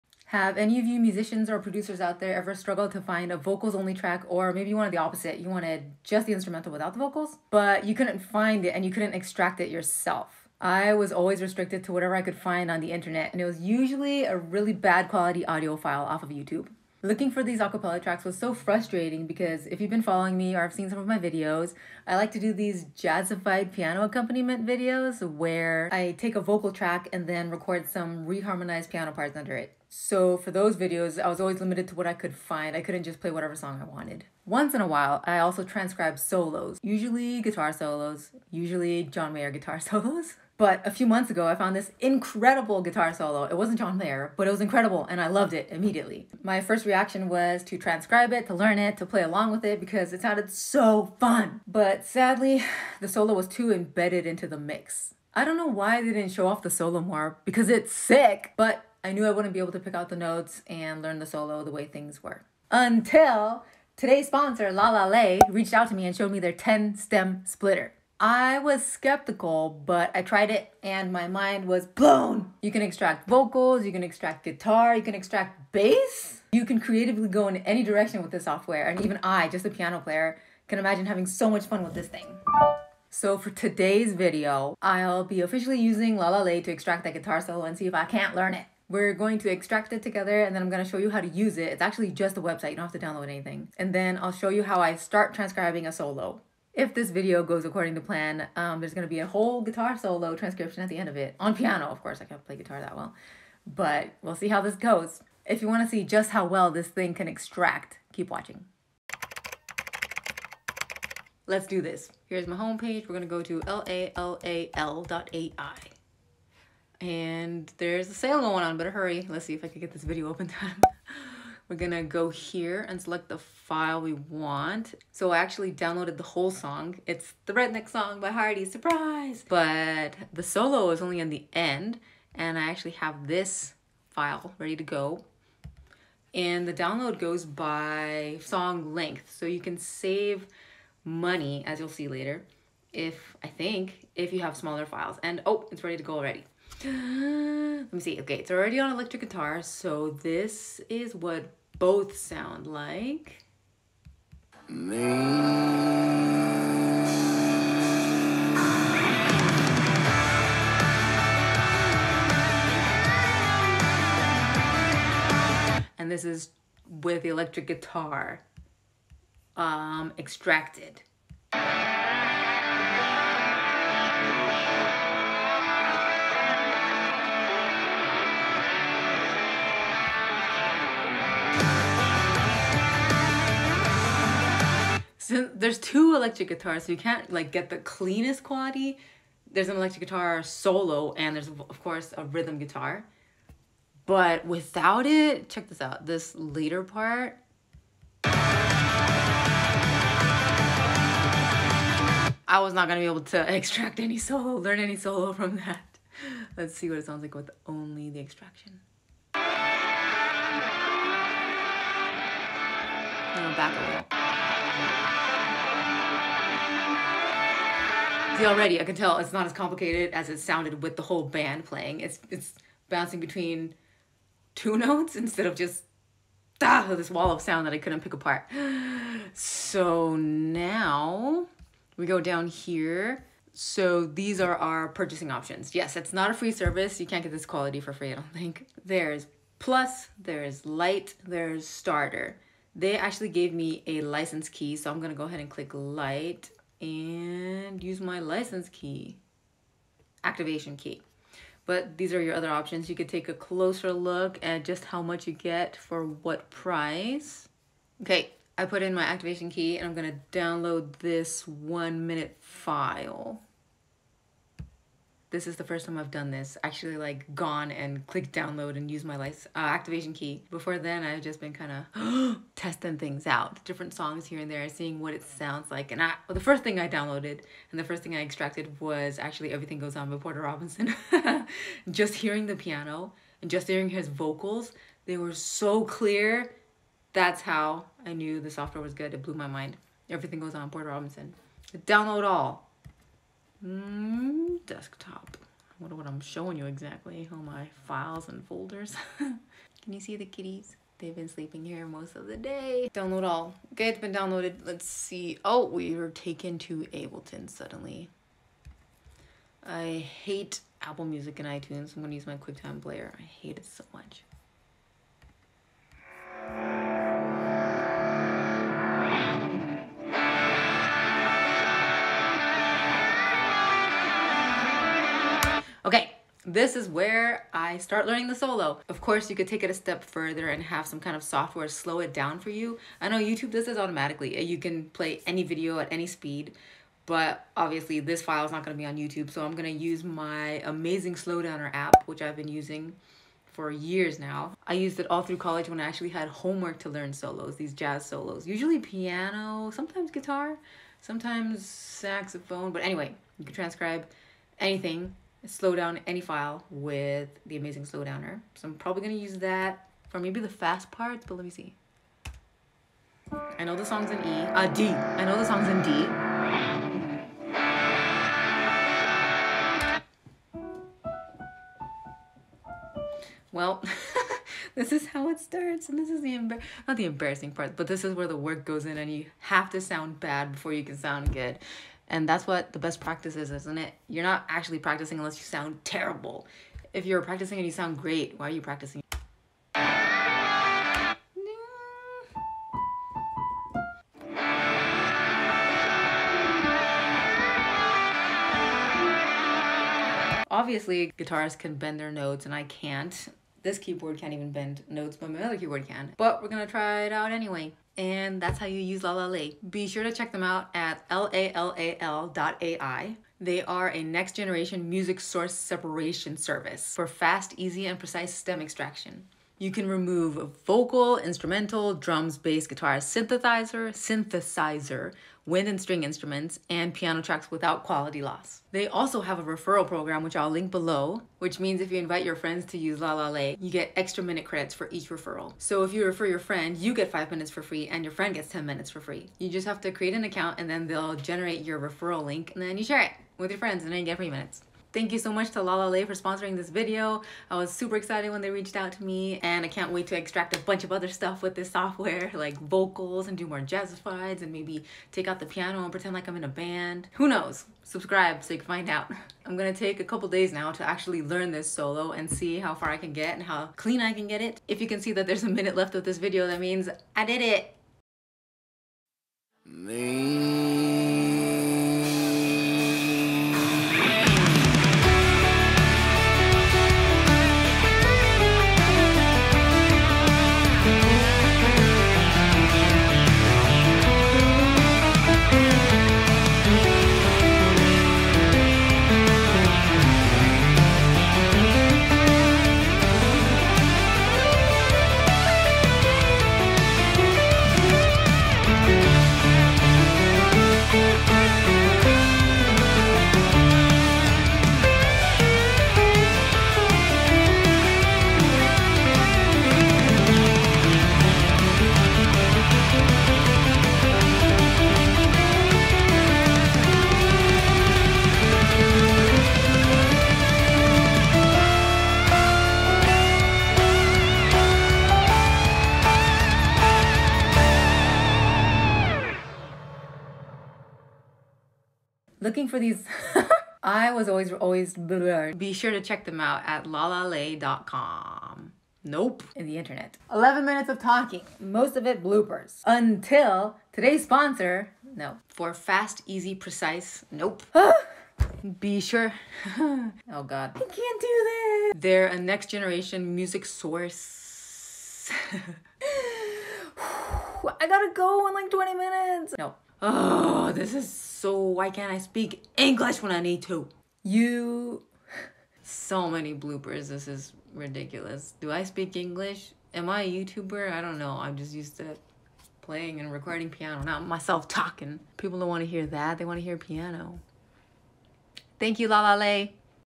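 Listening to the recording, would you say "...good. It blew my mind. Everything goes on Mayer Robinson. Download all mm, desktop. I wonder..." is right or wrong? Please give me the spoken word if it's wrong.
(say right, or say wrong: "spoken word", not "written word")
wrong: "Porter", not "Mayer".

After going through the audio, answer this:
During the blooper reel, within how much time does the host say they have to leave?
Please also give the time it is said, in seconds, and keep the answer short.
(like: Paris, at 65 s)
20 minutes, at 558 s.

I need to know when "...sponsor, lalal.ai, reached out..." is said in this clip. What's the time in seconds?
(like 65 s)
64 s.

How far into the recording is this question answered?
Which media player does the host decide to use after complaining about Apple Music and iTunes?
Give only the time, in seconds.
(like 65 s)
312 s.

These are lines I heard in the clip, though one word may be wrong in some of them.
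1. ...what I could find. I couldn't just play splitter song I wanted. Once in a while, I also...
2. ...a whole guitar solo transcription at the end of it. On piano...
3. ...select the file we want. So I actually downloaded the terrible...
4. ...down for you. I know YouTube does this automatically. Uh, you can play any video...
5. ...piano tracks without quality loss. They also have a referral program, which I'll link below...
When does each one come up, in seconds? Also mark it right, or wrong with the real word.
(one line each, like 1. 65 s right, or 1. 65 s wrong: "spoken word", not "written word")
1. 31 s wrong: "whatever", not "splitter"
2. 99 s right
3. 123 s wrong: "whole", not "terrible"
4. 332 s right
5. 426 s right.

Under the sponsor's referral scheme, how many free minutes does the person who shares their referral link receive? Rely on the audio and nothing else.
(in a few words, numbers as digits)
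5.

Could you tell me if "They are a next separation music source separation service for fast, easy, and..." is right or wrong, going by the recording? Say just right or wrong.
wrong.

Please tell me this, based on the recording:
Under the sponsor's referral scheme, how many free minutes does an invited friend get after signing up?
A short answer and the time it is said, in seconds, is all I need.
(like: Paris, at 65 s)
10, at 438 s.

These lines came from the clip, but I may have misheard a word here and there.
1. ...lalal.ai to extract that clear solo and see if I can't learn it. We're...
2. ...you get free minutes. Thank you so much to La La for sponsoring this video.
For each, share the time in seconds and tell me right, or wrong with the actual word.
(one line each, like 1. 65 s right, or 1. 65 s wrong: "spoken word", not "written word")
1. 86 s wrong: "guitar", not "clear"
2. 443 s right.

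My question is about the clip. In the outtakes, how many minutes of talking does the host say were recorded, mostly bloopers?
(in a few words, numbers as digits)
11.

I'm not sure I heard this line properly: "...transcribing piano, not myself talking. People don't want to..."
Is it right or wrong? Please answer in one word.
wrong.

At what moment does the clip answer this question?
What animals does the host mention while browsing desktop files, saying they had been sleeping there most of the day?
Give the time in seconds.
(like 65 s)
300 s.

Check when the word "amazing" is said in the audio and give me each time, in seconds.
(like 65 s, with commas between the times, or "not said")
340 s, 357 s.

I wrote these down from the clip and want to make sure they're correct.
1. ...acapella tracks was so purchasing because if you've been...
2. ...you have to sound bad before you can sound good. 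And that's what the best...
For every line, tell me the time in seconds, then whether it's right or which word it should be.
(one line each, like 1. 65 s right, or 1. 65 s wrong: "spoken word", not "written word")
1. 17 s wrong: "frustrating", not "purchasing"
2. 379 s right.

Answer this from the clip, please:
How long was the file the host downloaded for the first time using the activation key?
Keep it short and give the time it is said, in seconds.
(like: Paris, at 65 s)
1 minute, at 261 s.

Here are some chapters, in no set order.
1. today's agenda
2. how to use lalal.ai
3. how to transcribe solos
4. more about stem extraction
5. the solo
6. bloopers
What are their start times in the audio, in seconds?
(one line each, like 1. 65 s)
1. 83 s
2. 111 s
3. 325 s
4. 409 s
5. 468 s
6. 532 s.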